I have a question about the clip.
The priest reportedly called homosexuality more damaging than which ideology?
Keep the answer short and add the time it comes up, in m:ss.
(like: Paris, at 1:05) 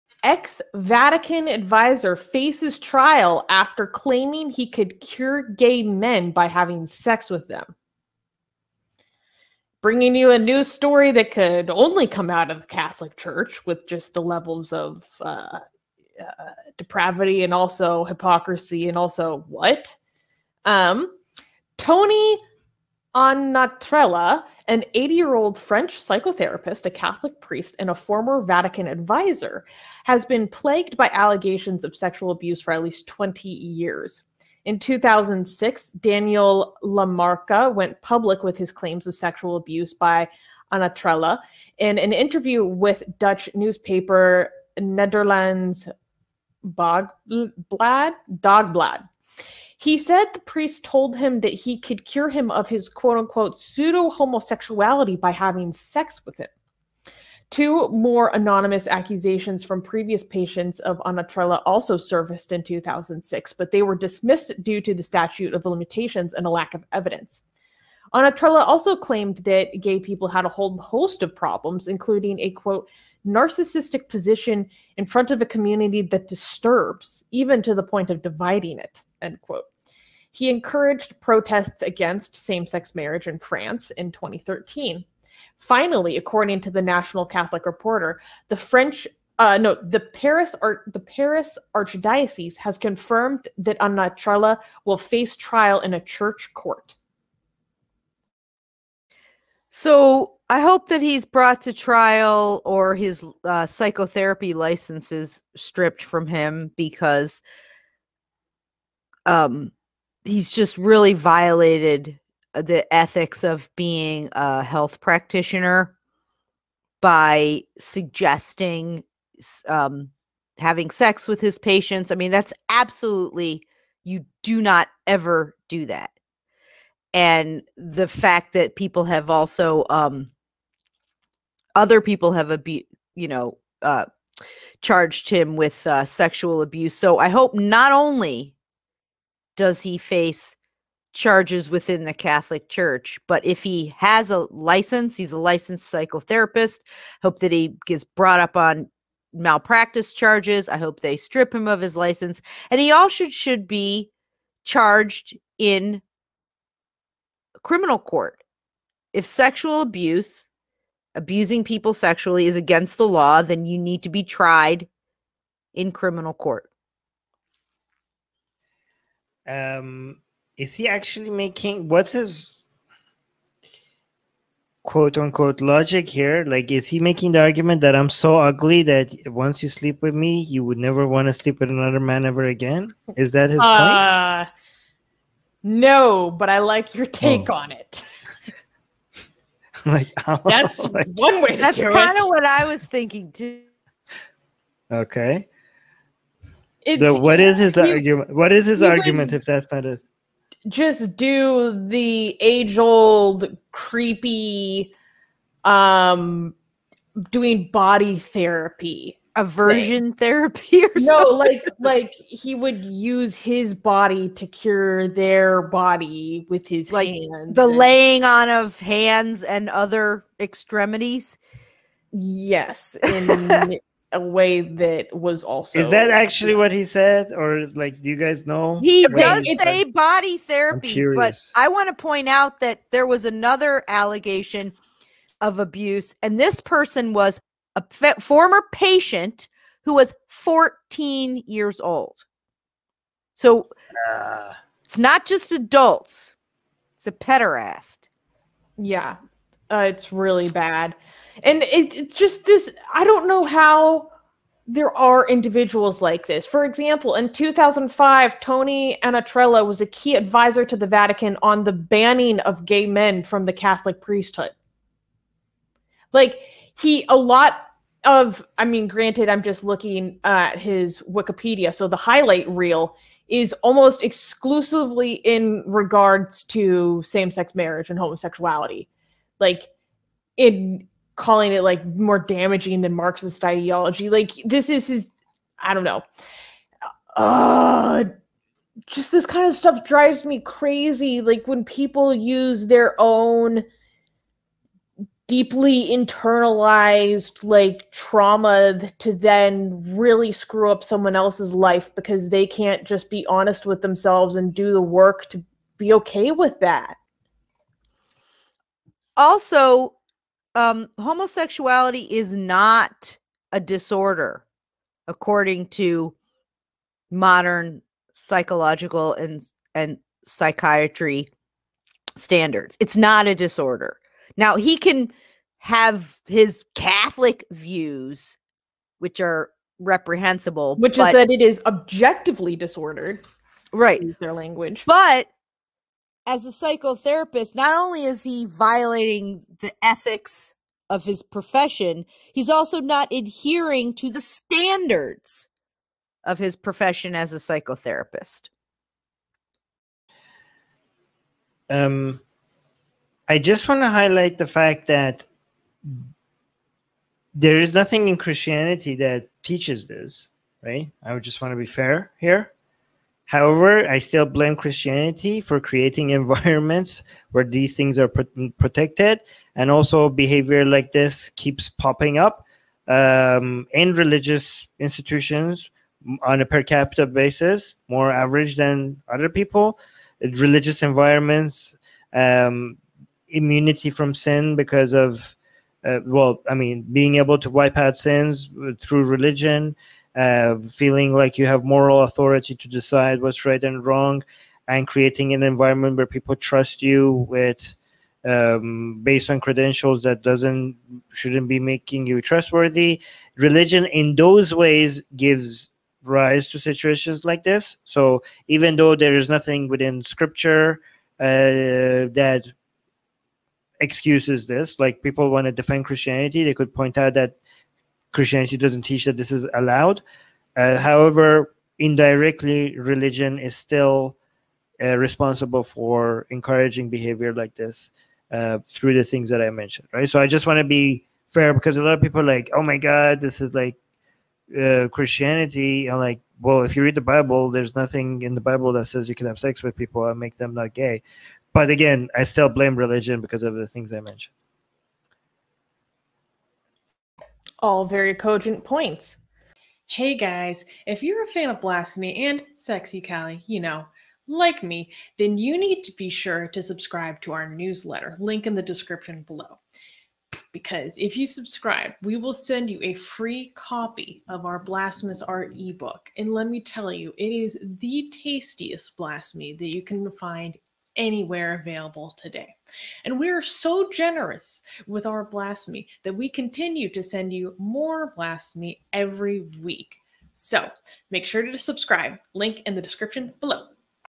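Marxist ideology, at 4:42.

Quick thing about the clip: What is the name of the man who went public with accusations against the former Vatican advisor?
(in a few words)
Daniel Lamarca.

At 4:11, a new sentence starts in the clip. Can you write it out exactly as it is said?
And it, it's just this I don't know how there are individuals like this.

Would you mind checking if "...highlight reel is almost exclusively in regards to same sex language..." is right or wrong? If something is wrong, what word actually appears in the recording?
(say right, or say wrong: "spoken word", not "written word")
wrong: "marriage", not "language".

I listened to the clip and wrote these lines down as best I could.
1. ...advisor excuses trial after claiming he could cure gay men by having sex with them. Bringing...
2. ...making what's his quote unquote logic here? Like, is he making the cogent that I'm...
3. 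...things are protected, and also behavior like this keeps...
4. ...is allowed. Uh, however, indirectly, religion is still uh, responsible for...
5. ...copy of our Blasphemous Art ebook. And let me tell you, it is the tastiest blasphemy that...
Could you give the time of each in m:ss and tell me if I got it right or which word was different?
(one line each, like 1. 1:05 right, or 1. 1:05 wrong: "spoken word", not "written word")
1. 0:01 wrong: "faces", not "excuses"
2. 2:51 wrong: "argument", not "cogent"
3. 6:07 right
4. 6:59 right
5. 7:43 right.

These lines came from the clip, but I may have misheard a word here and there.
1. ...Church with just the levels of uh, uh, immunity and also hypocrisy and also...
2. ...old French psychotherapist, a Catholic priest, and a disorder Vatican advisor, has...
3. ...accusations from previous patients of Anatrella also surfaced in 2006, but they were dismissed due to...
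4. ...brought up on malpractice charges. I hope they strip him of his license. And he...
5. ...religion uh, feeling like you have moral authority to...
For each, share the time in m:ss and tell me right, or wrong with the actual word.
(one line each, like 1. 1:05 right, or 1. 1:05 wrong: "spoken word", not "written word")
1. 0:13 wrong: "depravity", not "immunity"
2. 0:25 wrong: "former", not "disorder"
3. 0:58 right
4. 2:28 right
5. 6:29 right.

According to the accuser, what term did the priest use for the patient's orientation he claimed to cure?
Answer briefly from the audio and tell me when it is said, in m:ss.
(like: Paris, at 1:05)
pseudo homosexuality, at 0:53.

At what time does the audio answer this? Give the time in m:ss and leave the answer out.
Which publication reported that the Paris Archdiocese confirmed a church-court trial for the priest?
1:26.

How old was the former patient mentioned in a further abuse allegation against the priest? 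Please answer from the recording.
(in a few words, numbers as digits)
14.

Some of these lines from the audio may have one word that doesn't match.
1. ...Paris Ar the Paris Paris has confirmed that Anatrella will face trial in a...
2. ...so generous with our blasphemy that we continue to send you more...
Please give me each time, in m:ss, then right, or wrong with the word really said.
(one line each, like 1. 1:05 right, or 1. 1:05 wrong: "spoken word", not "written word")
1. 1:29 wrong: "Archdiocese", not "Paris"
2. 7:53 right.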